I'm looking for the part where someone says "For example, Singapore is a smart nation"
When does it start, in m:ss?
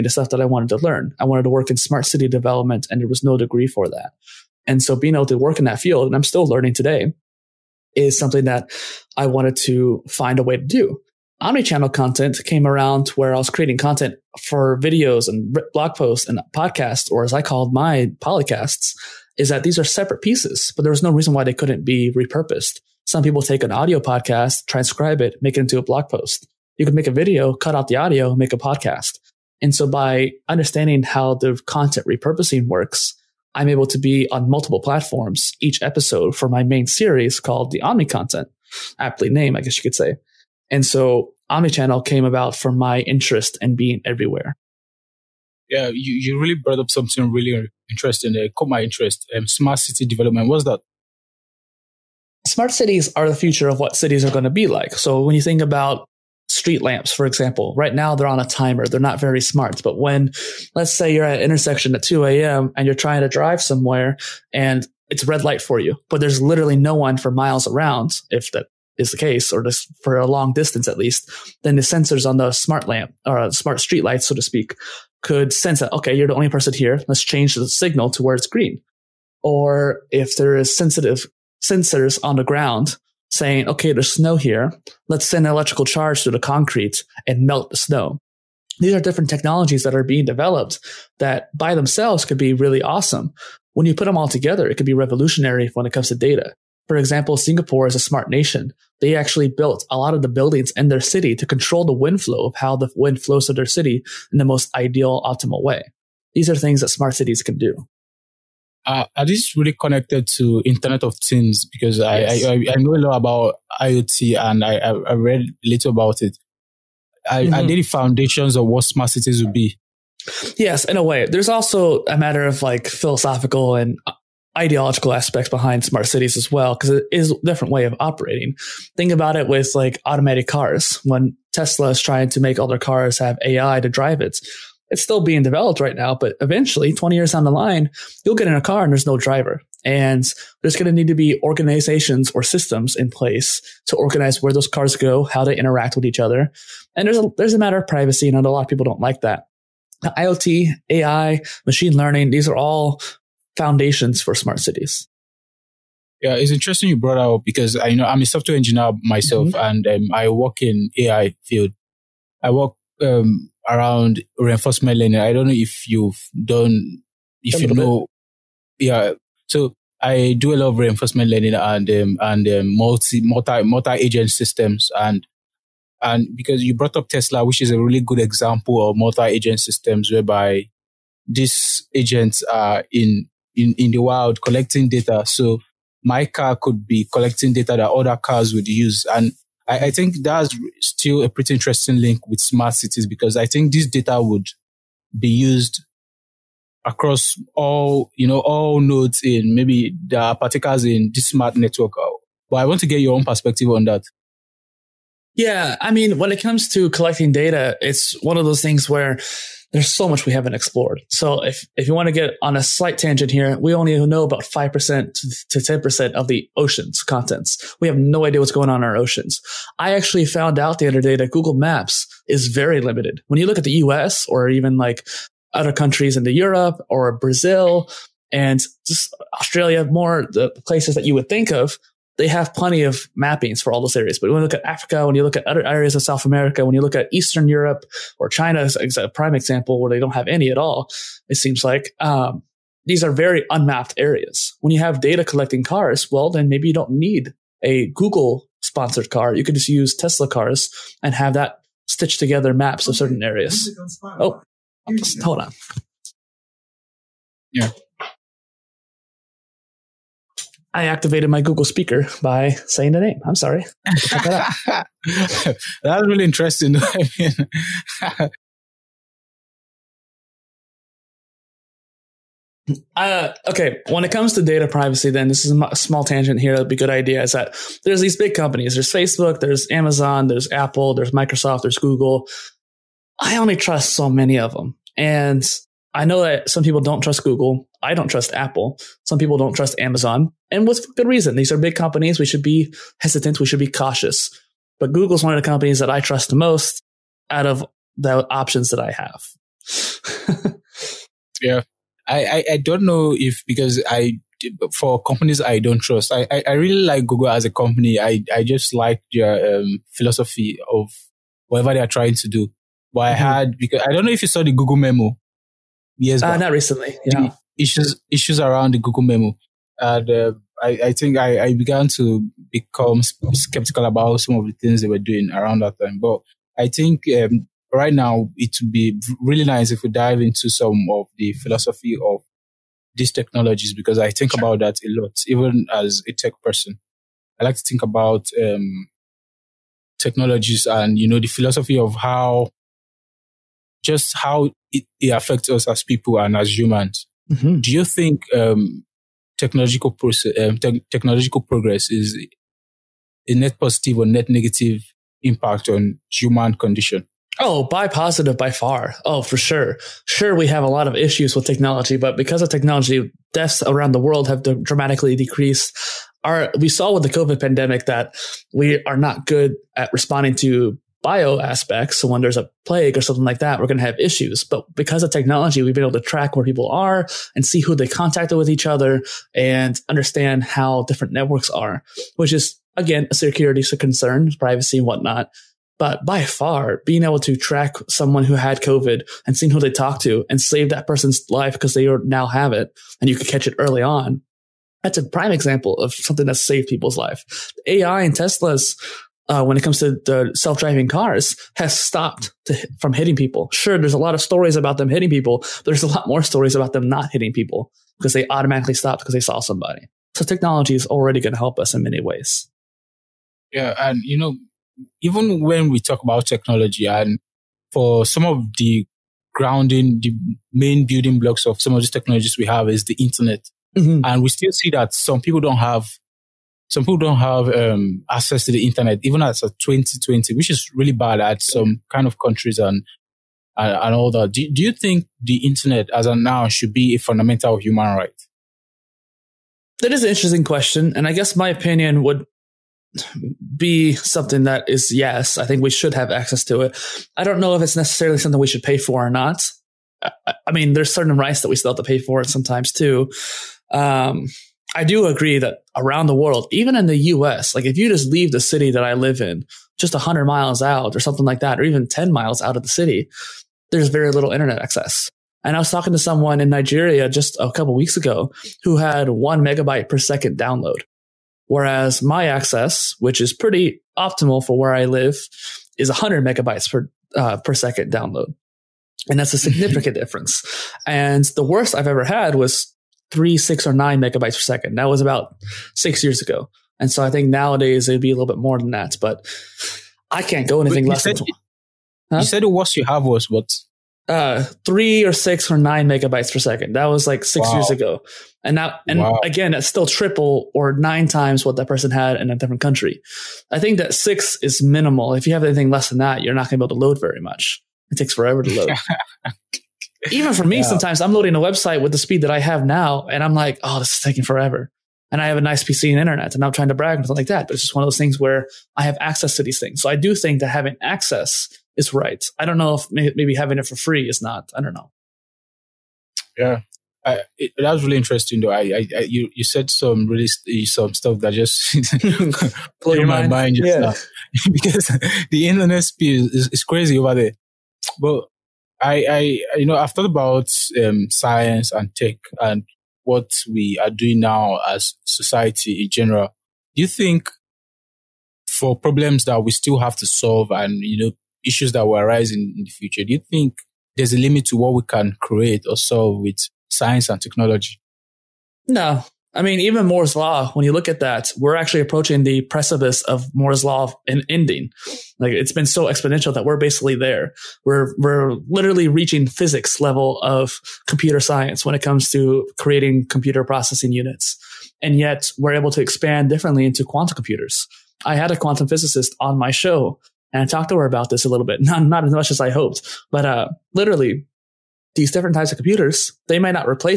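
1:36.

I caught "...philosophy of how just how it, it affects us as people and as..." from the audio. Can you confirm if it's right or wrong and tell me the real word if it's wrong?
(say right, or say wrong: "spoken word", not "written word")
right.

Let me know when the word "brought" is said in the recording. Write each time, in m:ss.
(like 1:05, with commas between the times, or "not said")
0:46, 2:36, 2:56.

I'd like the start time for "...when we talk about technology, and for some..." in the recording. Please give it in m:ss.
6:55.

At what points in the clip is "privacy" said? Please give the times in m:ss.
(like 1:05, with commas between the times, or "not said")
2:27, 4:34, 6:24.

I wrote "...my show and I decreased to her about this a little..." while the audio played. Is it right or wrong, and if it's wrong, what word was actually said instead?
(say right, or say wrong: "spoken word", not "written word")
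wrong: "talked", not "decreased".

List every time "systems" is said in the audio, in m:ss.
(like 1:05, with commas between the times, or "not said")
2:22, 2:54, 2:59.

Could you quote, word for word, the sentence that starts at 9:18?
No, I mean, even Moore's Law, when you look at that, we're actually approaching the precipice of Moore's Law and ending.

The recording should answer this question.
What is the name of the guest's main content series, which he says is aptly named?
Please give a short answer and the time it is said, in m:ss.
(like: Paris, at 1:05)
The Omni content, at 0:37.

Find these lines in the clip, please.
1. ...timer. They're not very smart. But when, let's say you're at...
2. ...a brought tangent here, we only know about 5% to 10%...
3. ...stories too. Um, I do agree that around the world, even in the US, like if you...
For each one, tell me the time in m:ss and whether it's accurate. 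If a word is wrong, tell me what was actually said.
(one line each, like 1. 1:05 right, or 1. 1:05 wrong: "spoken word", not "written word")
1. 0:58 right
2. 3:32 wrong: "slight", not "brought"
3. 7:32 wrong: "sometimes", not "stories".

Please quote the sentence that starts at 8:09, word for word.
But I can't go anything less said, than.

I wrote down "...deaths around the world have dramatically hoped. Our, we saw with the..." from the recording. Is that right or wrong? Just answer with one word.
wrong.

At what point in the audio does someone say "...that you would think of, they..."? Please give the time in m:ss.
3:50.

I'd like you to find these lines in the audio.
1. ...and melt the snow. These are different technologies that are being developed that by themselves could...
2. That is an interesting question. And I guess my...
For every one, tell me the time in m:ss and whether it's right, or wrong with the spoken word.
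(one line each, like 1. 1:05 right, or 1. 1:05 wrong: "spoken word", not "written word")
1. 1:27 right
2. 7:19 right.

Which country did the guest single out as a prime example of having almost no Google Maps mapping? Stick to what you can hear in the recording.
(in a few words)
China.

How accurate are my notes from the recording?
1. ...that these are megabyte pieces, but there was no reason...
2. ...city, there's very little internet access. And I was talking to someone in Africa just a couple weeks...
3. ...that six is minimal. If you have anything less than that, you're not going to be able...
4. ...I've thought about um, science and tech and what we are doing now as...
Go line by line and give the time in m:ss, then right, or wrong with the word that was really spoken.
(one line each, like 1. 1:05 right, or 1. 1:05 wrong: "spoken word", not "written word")
1. 0:19 wrong: "separate", not "megabyte"
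2. 7:42 wrong: "Nigeria", not "Africa"
3. 8:23 right
4. 8:59 right.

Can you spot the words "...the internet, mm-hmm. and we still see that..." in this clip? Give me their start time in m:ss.
7:02.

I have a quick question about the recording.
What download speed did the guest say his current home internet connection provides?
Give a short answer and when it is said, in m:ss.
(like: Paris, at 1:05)
100 megabytes per second, at 7:55.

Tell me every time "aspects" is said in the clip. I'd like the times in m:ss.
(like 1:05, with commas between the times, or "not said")
2:05, 6:11.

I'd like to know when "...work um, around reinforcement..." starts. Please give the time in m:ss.
2:42.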